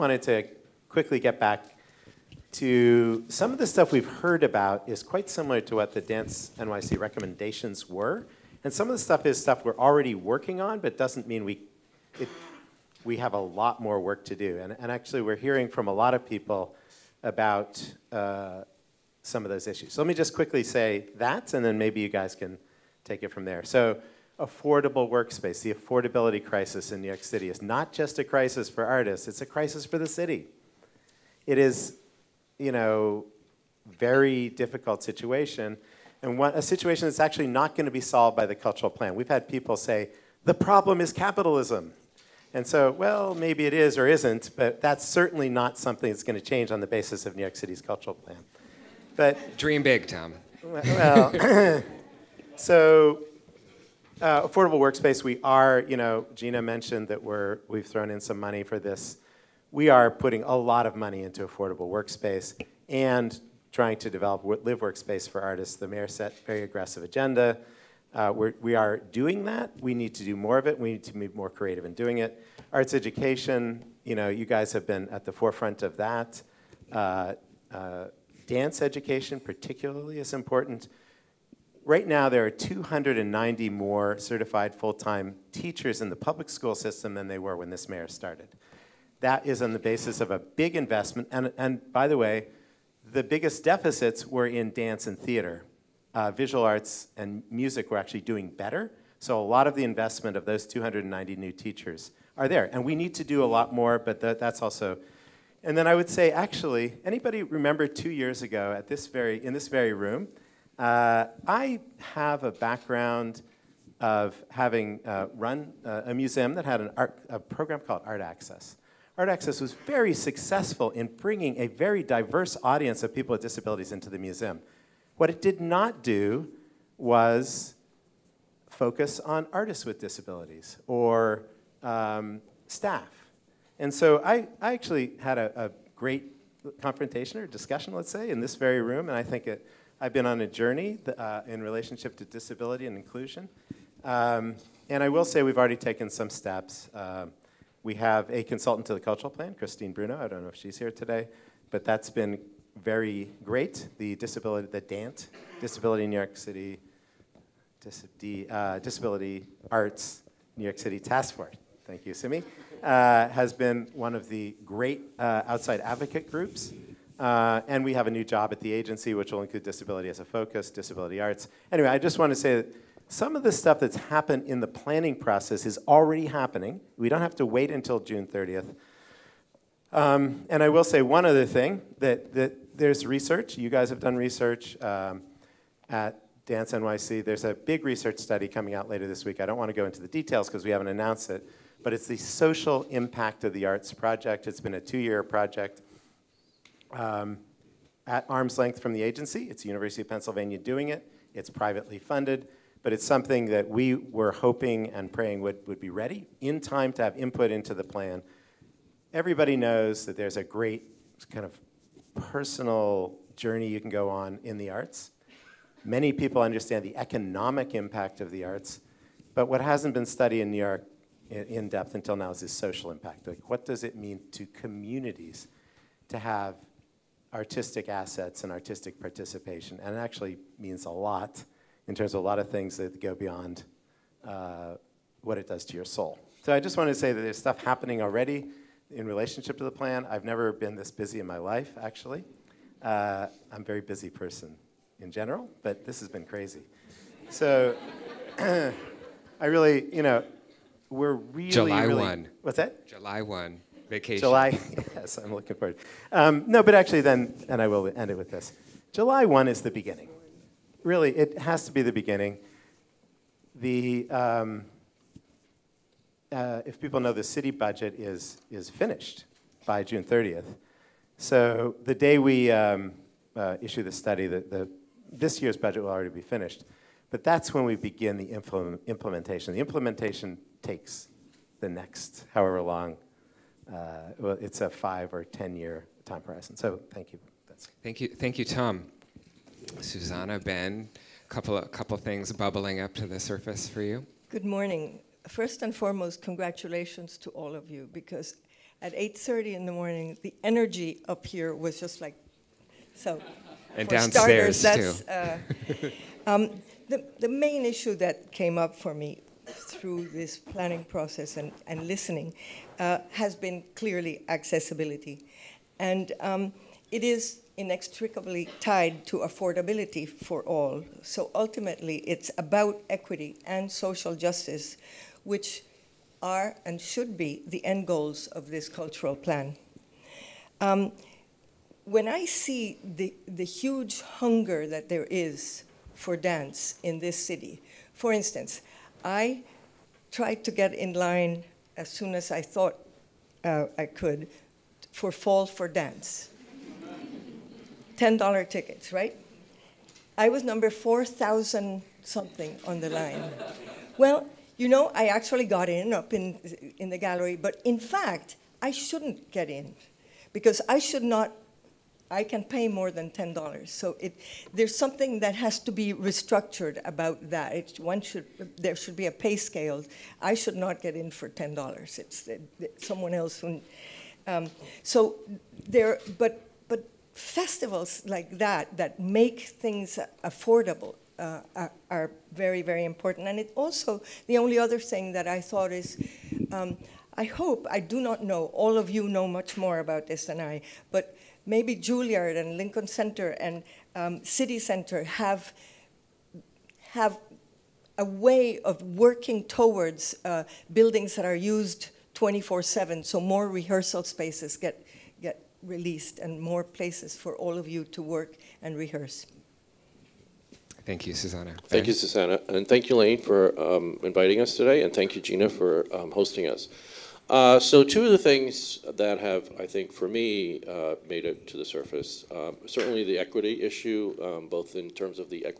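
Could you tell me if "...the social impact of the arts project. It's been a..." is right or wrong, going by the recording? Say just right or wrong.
right.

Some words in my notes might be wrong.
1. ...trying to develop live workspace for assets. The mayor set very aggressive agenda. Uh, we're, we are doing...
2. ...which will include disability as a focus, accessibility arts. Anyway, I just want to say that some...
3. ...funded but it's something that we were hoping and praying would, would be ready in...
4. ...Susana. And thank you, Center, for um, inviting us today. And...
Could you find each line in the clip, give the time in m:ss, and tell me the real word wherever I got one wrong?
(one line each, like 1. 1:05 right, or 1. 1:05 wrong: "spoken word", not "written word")
1. 1:03 wrong: "artists", not "assets"
2. 2:49 wrong: "disability", not "accessibility"
3. 3:21 right
4. 6:51 wrong: "Lane", not "Center".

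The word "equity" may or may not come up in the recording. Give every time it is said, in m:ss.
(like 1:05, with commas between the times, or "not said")
5:22, 7:03.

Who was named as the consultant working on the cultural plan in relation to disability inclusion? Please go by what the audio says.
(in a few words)
Christine Bruno.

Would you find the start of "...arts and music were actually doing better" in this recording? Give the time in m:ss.
1:36.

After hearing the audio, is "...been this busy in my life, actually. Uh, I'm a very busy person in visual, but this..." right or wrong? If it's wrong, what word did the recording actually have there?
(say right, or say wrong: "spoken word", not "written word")
wrong: "general", not "visual".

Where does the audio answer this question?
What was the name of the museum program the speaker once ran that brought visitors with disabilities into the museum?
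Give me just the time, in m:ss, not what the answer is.
1:58.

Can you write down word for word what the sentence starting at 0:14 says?
And, and actually, we're hearing from a lot of people about uh, some of those issues.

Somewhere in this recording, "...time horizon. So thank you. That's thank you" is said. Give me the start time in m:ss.
4:46.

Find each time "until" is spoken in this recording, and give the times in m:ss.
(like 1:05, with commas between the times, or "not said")
2:57, 3:41.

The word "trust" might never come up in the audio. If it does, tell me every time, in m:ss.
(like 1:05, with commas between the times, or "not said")
not said.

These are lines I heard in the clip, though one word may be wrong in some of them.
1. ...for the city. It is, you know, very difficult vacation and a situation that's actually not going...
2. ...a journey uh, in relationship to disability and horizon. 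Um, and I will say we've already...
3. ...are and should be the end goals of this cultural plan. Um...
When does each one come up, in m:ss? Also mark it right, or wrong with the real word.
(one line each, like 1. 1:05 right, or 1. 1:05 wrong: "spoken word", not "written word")
1. 0:29 wrong: "situation", not "vacation"
2. 2:20 wrong: "inclusion", not "horizon"
3. 5:26 right.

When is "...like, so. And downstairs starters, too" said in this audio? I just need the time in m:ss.
5:02.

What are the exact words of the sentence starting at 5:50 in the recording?
I was number 4,000 something on the line.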